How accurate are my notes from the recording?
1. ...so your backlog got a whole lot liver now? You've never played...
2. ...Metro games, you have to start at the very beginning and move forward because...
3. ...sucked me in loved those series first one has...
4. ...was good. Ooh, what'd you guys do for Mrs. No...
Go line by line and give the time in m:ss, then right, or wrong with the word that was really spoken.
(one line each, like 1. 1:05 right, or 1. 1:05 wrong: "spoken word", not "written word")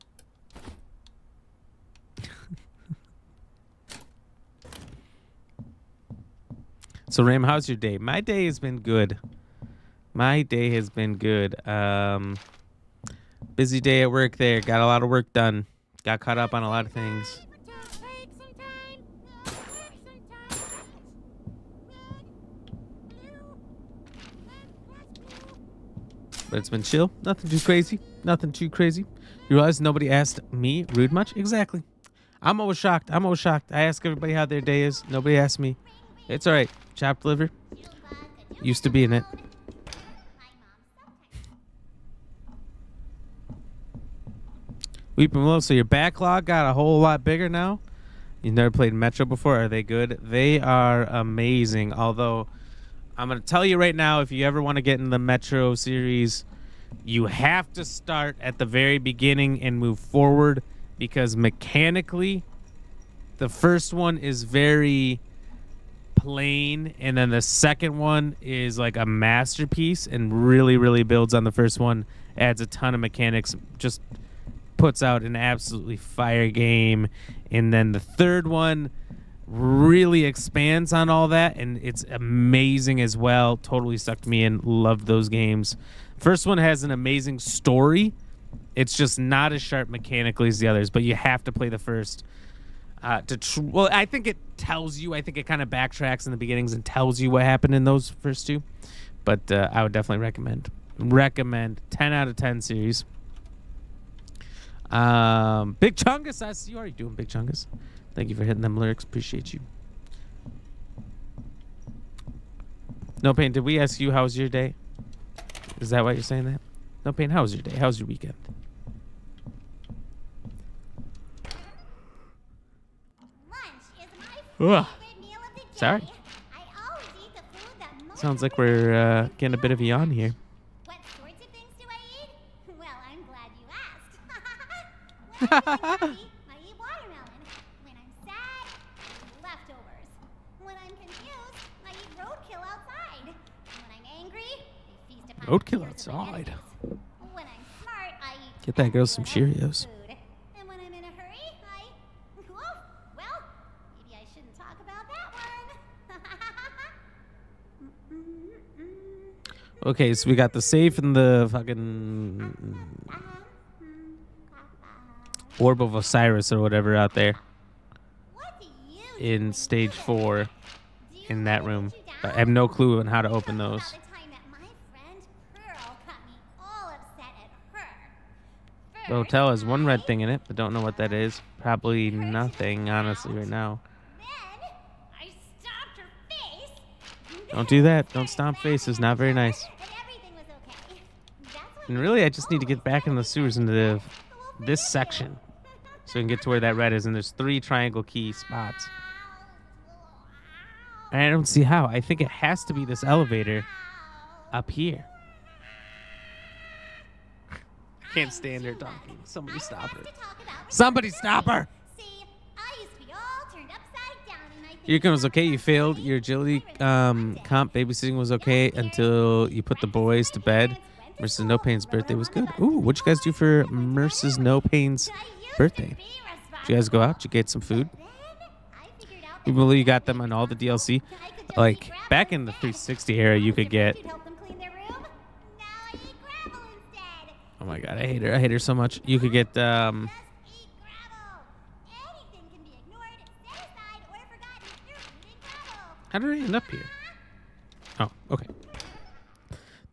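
1. 0:45 wrong: "bigger", not "liver"
2. 0:55 wrong: "series", not "games"
3. 1:23 wrong: "games", not "series"
4. 3:42 right.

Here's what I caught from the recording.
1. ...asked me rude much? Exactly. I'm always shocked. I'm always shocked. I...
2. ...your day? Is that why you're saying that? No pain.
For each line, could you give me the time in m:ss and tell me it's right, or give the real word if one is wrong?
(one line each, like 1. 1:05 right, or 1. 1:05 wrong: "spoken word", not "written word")
1. 0:30 right
2. 1:54 right.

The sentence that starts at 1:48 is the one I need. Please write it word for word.
Thank you for hitting them lyrics.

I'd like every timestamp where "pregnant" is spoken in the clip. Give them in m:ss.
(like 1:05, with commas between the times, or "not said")
not said.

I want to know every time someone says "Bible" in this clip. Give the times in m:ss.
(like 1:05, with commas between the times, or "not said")
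not said.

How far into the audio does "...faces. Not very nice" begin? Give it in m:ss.
3:08.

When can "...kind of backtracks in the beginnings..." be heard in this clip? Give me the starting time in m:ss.
1:35.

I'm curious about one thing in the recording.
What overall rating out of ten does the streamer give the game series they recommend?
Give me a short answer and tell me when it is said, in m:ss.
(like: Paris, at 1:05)
10 out of 10, at 1:41.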